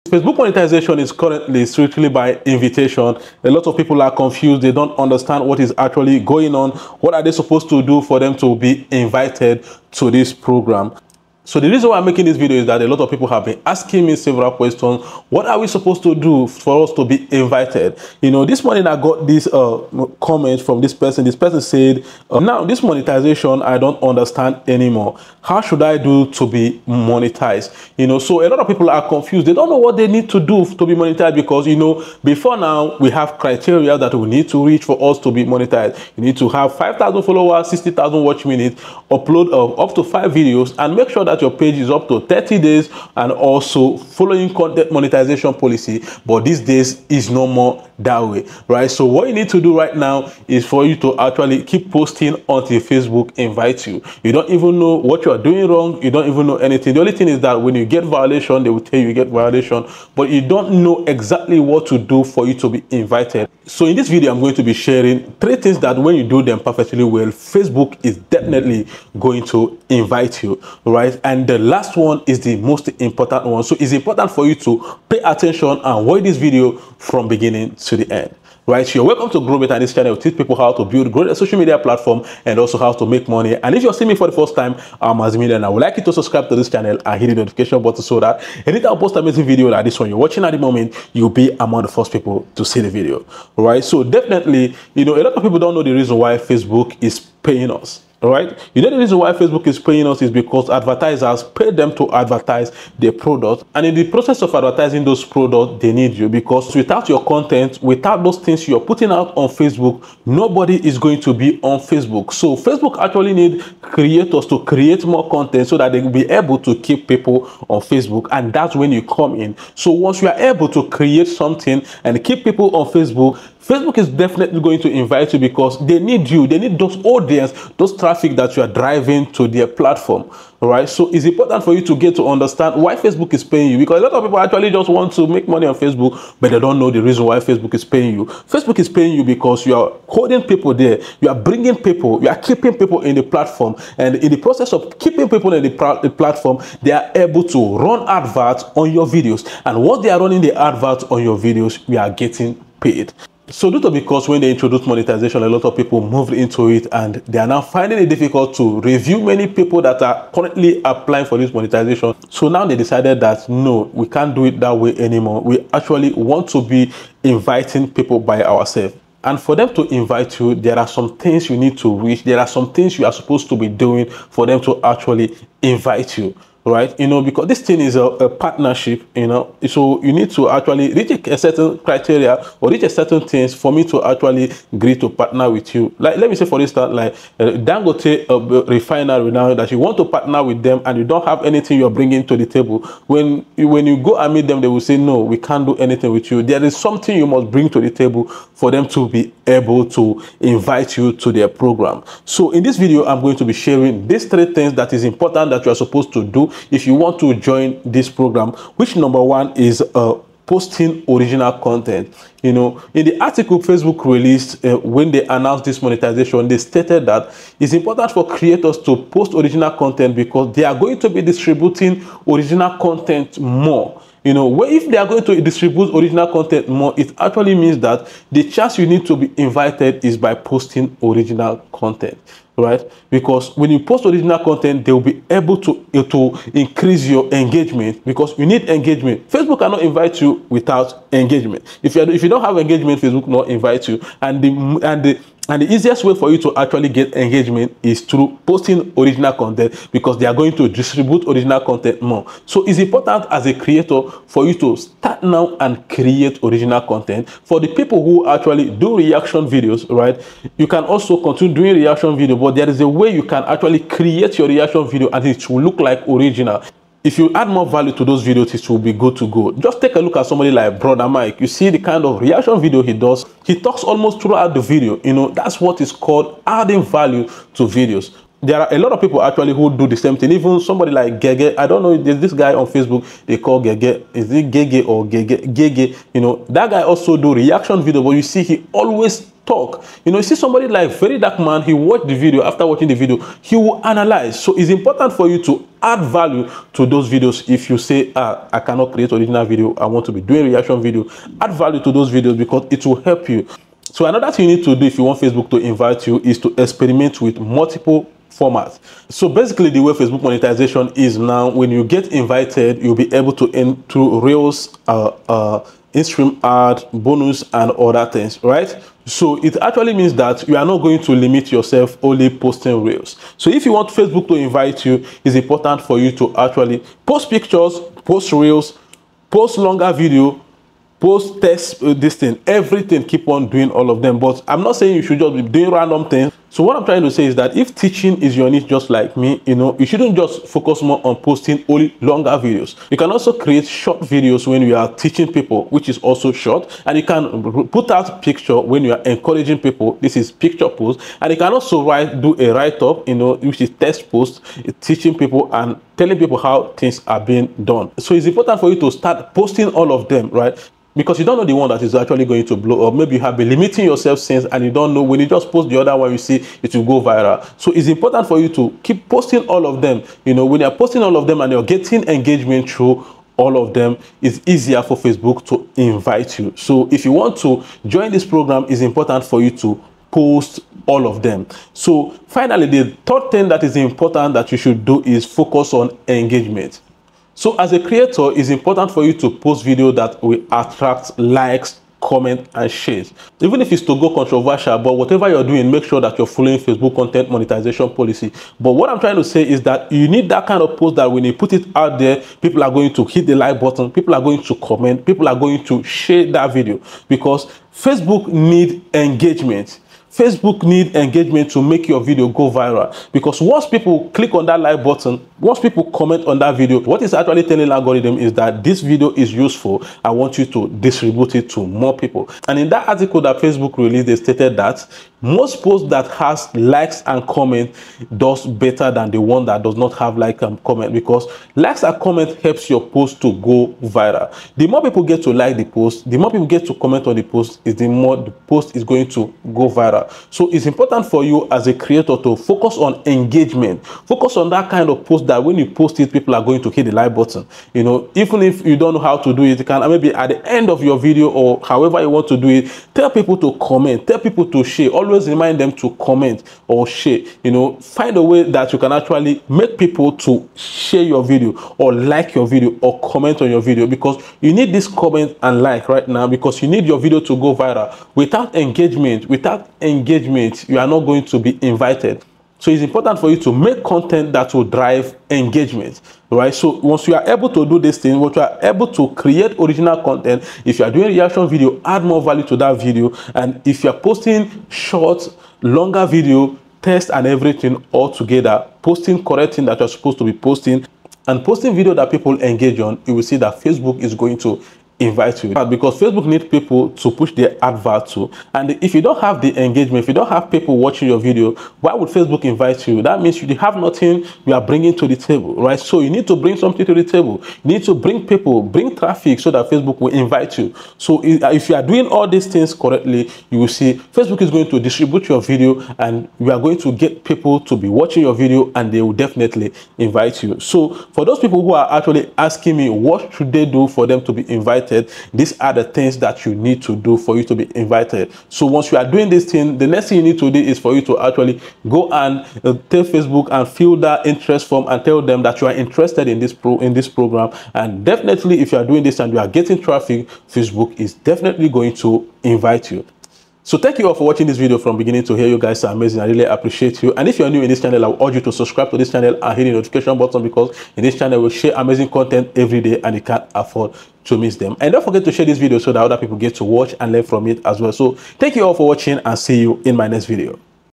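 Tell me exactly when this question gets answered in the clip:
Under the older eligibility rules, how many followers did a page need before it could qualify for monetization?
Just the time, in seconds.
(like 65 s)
36 s.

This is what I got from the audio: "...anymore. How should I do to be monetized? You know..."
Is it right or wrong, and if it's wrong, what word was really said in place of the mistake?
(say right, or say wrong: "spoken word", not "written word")
right.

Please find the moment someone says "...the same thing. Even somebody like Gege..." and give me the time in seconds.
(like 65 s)
279 s.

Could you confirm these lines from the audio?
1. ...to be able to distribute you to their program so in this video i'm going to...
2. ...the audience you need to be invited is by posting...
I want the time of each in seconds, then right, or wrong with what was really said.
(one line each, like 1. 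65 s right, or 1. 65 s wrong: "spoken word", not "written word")
1. 198 s wrong: "invite", not "distribute"
2. 228 s wrong: "chance", not "audience".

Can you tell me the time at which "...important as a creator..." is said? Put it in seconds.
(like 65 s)
252 s.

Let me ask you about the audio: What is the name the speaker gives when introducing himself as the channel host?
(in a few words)
Azimila.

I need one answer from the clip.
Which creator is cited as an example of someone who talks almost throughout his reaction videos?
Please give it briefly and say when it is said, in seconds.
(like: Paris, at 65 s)
Brother Mike, at 270 s.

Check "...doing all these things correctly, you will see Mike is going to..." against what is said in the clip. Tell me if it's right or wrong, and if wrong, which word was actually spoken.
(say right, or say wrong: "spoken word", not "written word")
wrong: "Facebook", not "Mike".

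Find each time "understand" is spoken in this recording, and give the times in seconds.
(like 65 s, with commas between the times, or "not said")
4 s, 24 s, 132 s.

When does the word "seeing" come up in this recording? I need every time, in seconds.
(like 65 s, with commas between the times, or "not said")
83 s.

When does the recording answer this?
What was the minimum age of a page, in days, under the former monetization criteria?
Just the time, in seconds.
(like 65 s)
42 s.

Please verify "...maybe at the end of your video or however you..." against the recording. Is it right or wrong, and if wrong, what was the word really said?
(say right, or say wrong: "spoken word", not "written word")
right.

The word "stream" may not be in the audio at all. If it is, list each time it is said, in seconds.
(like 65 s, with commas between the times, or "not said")
315 s.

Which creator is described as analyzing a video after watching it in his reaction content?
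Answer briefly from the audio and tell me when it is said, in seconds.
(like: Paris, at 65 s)
Very Dark Man, at 290 s.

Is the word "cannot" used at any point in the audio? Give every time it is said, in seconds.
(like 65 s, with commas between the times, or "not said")
239 s, 298 s.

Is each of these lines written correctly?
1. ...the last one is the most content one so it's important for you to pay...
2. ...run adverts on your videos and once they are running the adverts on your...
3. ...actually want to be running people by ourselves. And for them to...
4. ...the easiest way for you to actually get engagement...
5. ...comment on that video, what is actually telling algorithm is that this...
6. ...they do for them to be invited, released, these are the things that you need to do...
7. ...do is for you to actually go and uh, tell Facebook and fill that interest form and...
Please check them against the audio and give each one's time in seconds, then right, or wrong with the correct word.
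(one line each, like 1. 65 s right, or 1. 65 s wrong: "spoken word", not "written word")
1. 71 s wrong: "important", not "content"
2. 147 s right
3. 165 s wrong: "inviting", not "running"
4. 245 s right
5. 415 s right
6. 523 s wrong: "invited", not "released"
7. 530 s right.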